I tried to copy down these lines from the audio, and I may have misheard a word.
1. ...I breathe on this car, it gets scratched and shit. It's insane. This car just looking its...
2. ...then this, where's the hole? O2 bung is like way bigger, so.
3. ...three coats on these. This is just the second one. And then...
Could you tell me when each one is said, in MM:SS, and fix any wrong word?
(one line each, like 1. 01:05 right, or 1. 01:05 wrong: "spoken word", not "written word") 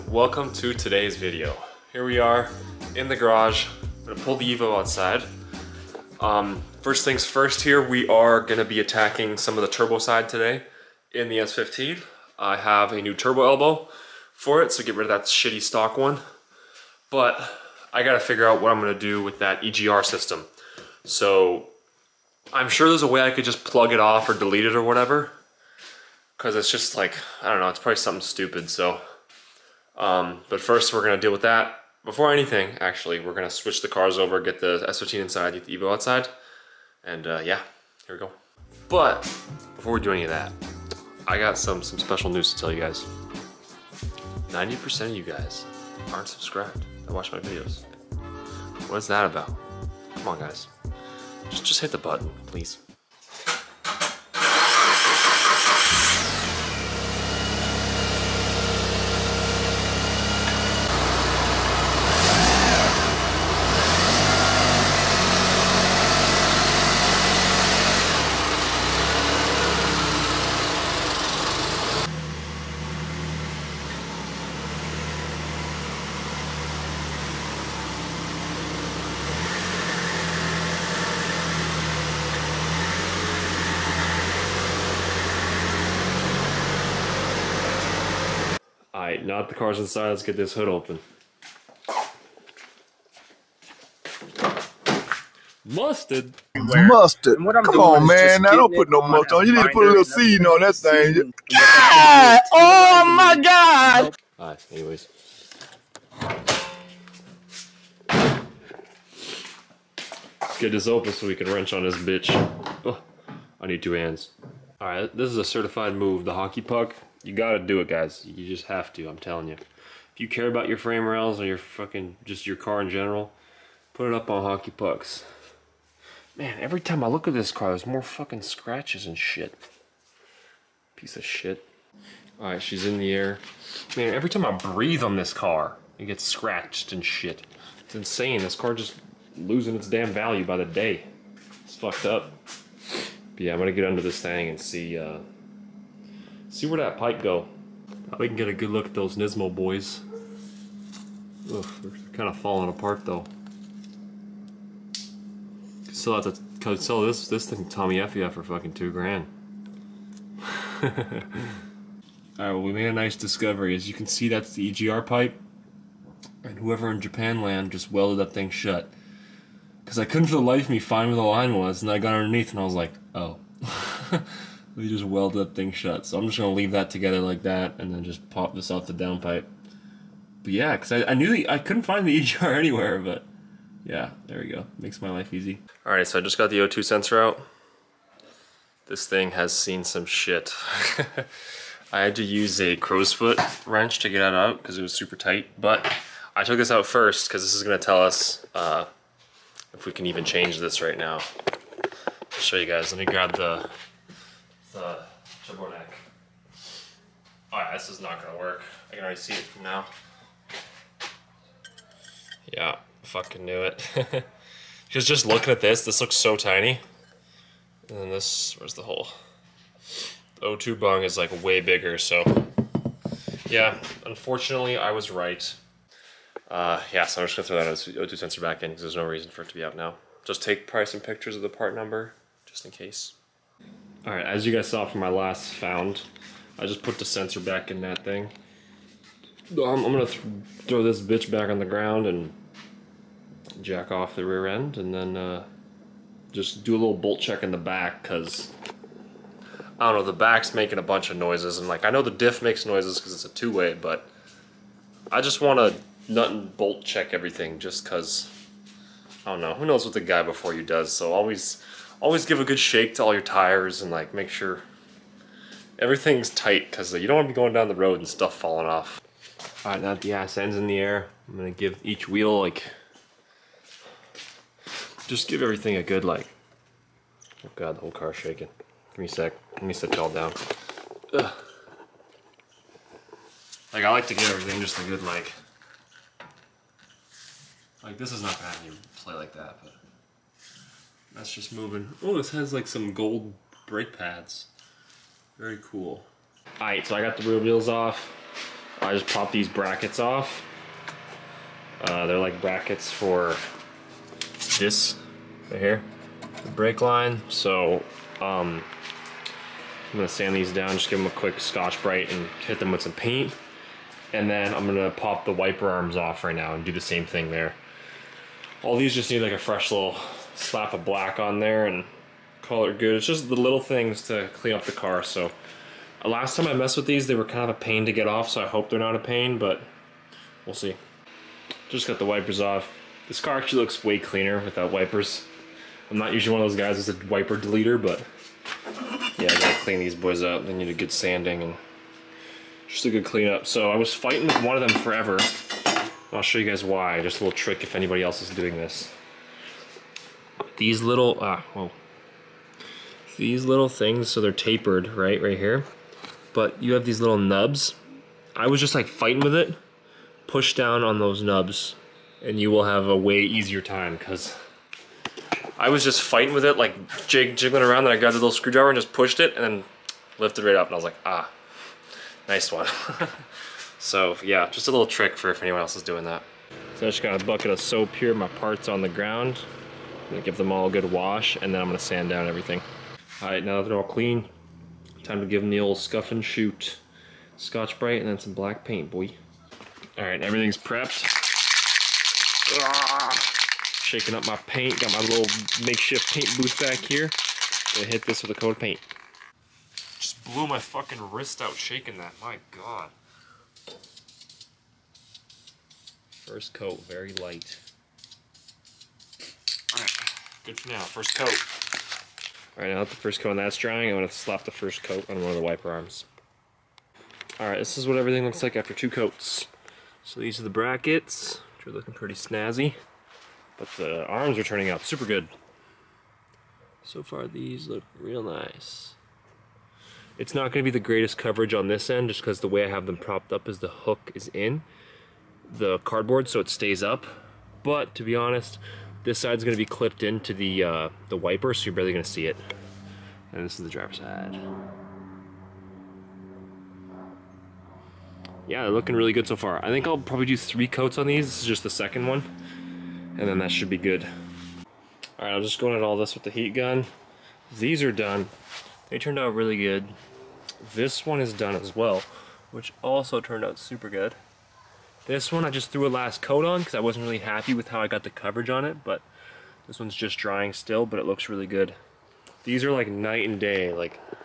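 1. 02:14 wrong: "losing", not "looking"
2. 03:37 right
3. 07:30 right.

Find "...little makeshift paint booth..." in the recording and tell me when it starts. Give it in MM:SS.
06:35.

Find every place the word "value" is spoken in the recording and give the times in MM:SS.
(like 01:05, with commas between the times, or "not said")
02:20.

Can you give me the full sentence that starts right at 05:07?
So um, I'm gonna sand these down, just give them a quick Scotch-Brite and hit them with some paint.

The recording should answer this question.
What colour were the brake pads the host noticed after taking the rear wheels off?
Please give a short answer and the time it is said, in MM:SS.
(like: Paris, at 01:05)
Gold, at 04:52.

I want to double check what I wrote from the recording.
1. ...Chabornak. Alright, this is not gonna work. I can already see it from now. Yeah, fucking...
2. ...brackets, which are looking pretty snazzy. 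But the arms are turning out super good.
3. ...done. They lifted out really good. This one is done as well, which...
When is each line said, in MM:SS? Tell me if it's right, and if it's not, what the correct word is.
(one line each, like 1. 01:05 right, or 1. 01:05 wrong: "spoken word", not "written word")
1. 03:25 right
2. 07:00 right
3. 07:37 wrong: "turned", not "lifted".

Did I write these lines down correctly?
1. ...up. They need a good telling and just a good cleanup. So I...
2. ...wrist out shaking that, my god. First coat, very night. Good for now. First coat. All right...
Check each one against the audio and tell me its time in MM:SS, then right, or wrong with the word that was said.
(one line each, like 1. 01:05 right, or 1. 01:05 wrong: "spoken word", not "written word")
1. 05:40 wrong: "sanding", not "telling"
2. 06:41 wrong: "light", not "night".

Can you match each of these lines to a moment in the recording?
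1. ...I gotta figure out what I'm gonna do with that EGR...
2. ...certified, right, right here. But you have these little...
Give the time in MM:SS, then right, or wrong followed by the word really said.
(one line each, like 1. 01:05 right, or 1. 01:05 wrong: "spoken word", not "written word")
1. 00:17 right
2. 05:54 wrong: "tapered", not "certified".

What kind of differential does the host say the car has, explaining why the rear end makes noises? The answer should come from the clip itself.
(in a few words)
Two-way.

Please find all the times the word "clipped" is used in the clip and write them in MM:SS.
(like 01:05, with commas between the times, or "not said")
07:19.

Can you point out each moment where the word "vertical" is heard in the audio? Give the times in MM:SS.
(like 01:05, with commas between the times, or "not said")
not said.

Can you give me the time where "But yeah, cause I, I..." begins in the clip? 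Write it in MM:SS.
03:00.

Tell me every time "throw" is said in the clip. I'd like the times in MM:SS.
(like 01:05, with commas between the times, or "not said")
03:47, 04:00.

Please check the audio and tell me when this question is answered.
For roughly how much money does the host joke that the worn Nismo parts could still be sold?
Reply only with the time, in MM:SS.
02:38.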